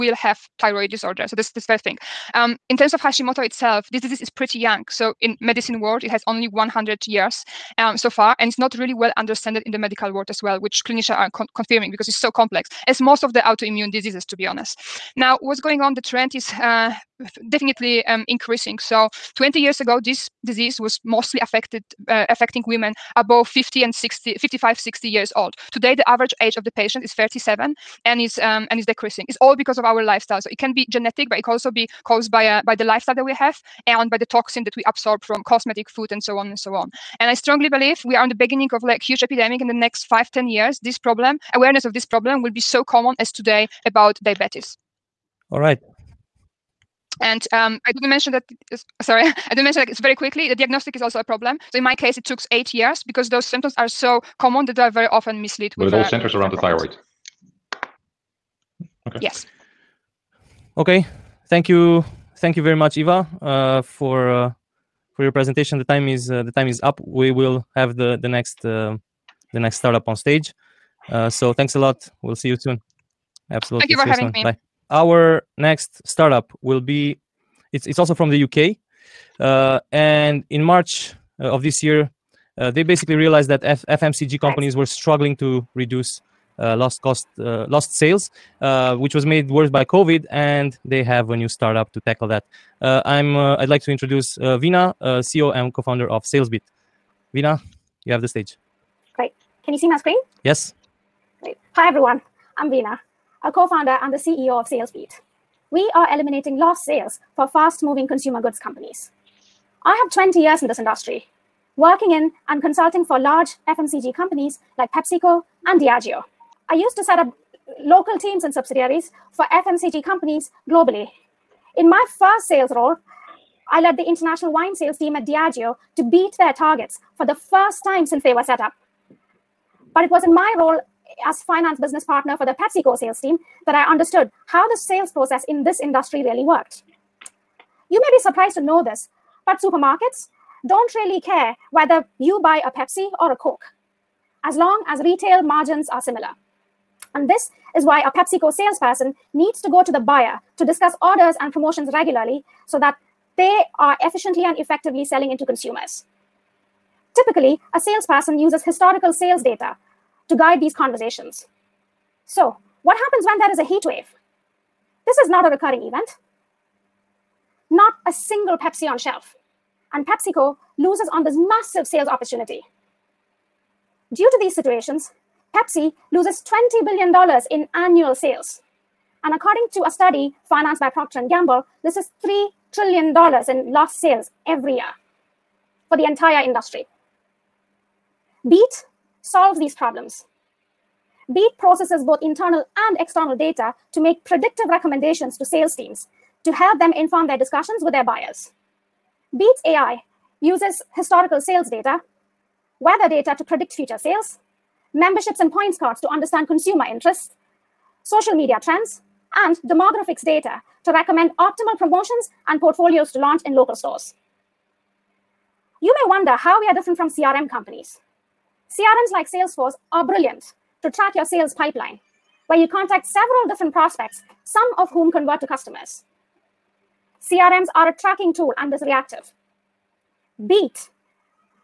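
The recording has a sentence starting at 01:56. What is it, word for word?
I used to set up local teams and subsidiaries for FMCG companies globally.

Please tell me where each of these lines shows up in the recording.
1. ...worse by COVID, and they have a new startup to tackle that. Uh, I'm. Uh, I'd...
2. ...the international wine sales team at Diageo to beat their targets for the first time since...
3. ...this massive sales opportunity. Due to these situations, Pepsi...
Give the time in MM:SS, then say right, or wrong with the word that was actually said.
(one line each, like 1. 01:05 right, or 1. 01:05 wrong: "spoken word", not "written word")
1. 01:29 right
2. 02:03 right
3. 02:51 right.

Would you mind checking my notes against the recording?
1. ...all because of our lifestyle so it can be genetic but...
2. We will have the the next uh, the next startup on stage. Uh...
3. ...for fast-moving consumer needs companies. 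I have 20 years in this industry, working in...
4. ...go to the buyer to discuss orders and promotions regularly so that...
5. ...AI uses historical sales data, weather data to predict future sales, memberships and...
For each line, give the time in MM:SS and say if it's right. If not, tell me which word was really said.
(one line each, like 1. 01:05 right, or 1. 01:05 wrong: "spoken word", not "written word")
1. 00:29 right
2. 01:07 right
3. 01:47 wrong: "goods", not "needs"
4. 02:29 right
5. 03:19 right.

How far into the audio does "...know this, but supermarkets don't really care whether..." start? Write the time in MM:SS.
02:18.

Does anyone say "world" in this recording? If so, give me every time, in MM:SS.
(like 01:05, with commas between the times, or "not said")
00:05, 00:10.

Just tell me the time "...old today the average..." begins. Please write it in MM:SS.
00:25.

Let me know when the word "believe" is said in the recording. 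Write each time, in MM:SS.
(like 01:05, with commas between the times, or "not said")
00:37.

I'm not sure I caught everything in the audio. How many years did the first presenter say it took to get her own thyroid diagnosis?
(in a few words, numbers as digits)
8 years.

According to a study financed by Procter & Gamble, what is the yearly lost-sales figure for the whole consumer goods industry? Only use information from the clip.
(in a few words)
$3 trillion.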